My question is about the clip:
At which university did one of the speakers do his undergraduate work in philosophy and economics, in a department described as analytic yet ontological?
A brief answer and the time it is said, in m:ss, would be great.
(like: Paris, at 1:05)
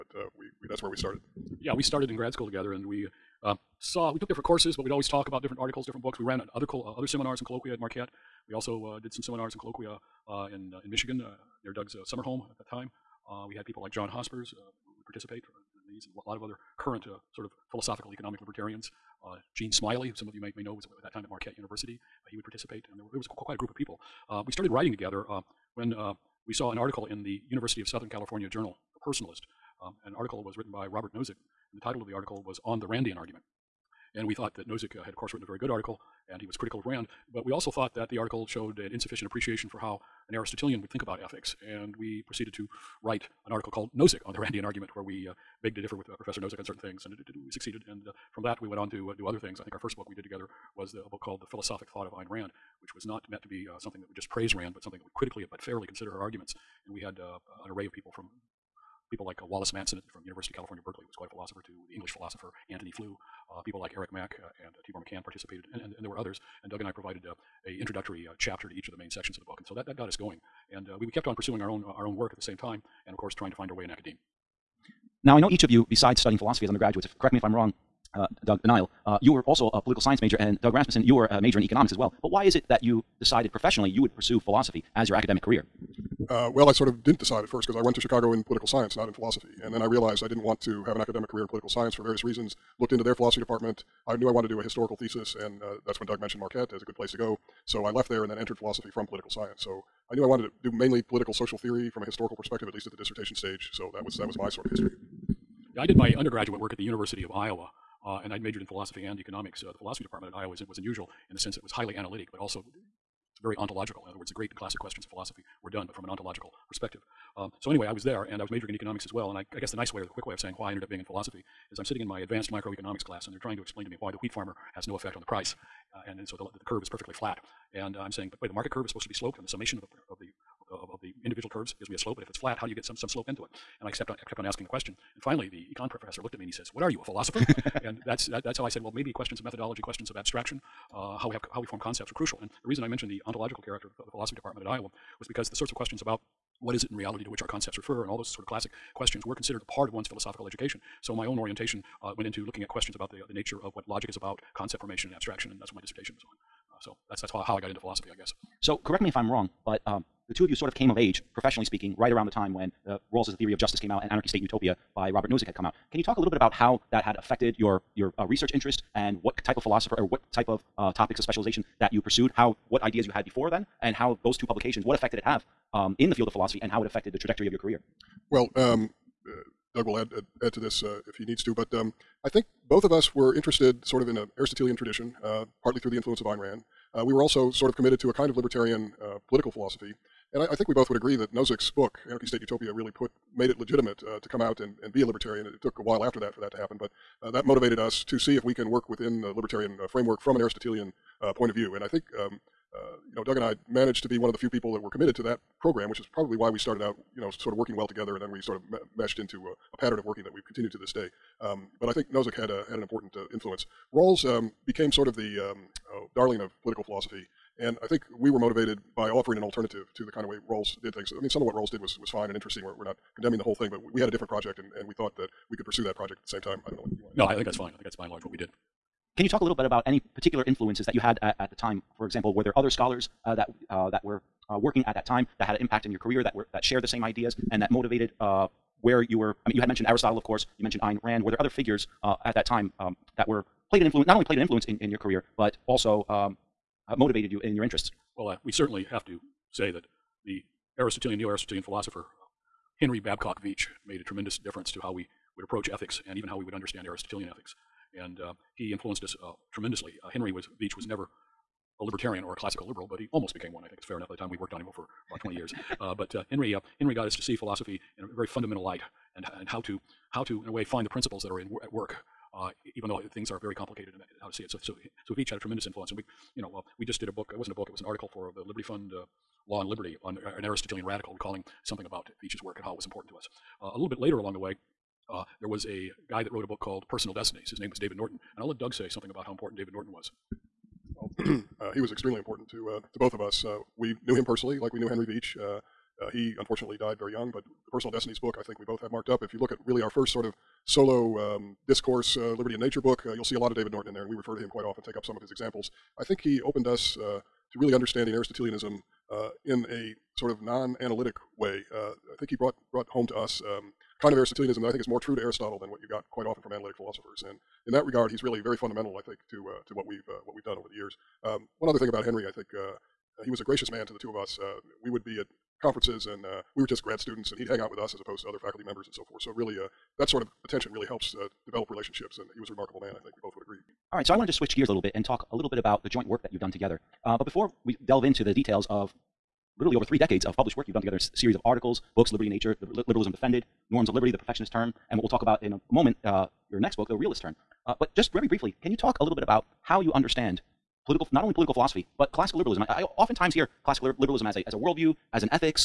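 University of Iowa, at 1:46.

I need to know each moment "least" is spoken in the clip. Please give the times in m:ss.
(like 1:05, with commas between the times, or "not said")
1:42.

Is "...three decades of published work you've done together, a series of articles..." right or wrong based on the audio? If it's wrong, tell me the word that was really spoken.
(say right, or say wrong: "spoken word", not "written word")
right.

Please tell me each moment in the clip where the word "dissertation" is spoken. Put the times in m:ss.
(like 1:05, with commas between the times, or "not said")
1:42, 2:35.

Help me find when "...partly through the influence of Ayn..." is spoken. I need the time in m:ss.
3:05.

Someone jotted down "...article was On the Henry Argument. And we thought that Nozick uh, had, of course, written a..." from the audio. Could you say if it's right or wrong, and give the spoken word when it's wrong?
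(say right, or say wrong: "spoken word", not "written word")
wrong: "Randian", not "Henry".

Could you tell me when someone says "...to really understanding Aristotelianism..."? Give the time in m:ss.
5:07.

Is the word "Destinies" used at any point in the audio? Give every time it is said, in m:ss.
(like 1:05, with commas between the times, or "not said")
4:47, 4:57.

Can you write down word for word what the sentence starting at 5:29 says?
So really, uh, that sort of attention really helps develop relationships, and he was a remarkable man.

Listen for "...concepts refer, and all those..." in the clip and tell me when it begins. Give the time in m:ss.
2:27.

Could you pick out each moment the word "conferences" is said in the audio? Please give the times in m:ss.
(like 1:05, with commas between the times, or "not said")
5:25.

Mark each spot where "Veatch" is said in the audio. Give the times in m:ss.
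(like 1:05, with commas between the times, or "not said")
4:13, 4:20, 4:35, 4:42.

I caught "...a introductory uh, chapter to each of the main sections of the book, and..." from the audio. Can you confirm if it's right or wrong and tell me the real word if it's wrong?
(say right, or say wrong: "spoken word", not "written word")
right.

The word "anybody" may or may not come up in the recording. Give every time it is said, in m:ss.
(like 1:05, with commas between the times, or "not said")
not said.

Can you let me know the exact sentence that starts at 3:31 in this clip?
Um, but I think Nozick had a, had an important uh, influence.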